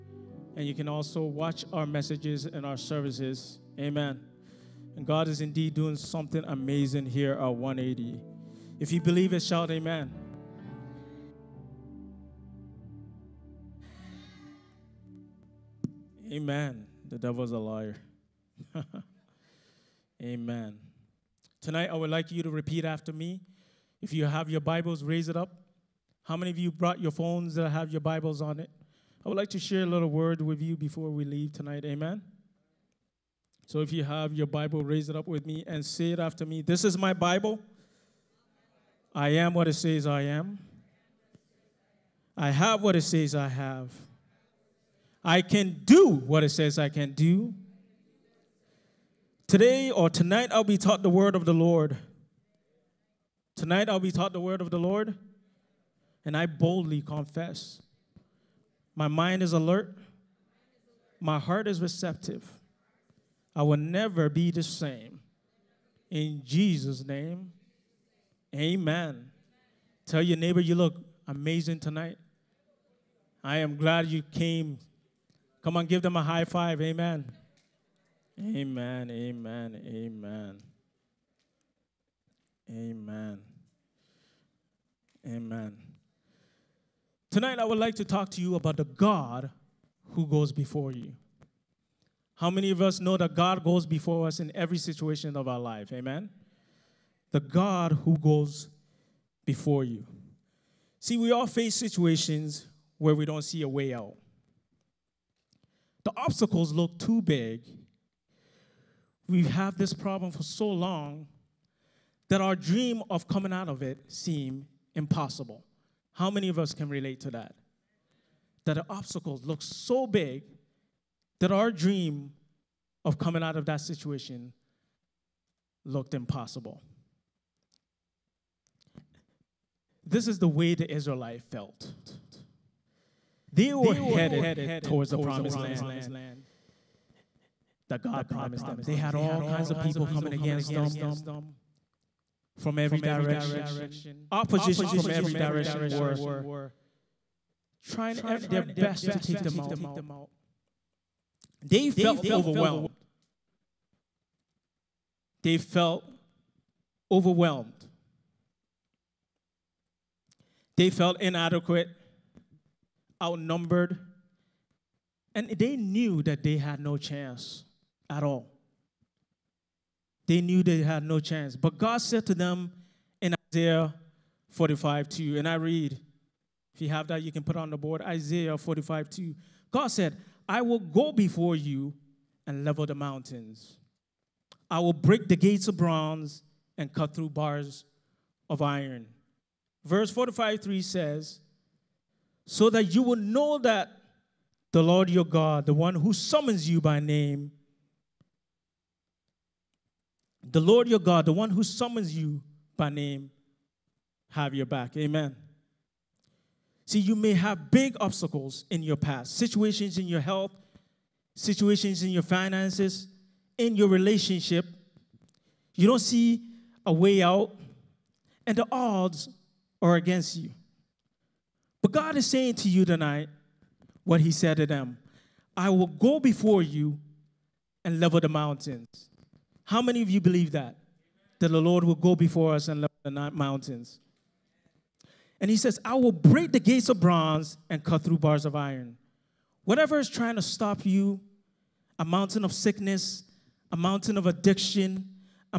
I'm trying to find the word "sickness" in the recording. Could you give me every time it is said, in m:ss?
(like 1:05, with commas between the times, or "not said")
4:02.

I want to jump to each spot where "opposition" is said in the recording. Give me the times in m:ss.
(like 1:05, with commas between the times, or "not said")
2:24.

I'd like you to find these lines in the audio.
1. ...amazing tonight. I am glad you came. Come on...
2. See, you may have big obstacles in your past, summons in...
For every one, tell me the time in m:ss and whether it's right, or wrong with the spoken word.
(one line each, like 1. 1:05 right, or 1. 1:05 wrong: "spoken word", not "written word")
1. 1:11 right
2. 3:26 wrong: "situations", not "summons".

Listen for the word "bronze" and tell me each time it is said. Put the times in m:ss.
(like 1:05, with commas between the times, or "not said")
3:05, 3:56.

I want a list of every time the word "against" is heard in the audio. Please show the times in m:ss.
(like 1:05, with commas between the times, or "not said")
2:20, 3:39.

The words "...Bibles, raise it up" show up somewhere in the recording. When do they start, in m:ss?
0:24.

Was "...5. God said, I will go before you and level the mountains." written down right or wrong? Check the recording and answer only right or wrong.
wrong.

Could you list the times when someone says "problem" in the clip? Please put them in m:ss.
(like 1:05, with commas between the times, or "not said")
1:49.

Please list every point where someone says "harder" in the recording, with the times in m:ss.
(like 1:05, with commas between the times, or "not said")
not said.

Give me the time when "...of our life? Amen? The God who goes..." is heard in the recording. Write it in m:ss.
1:35.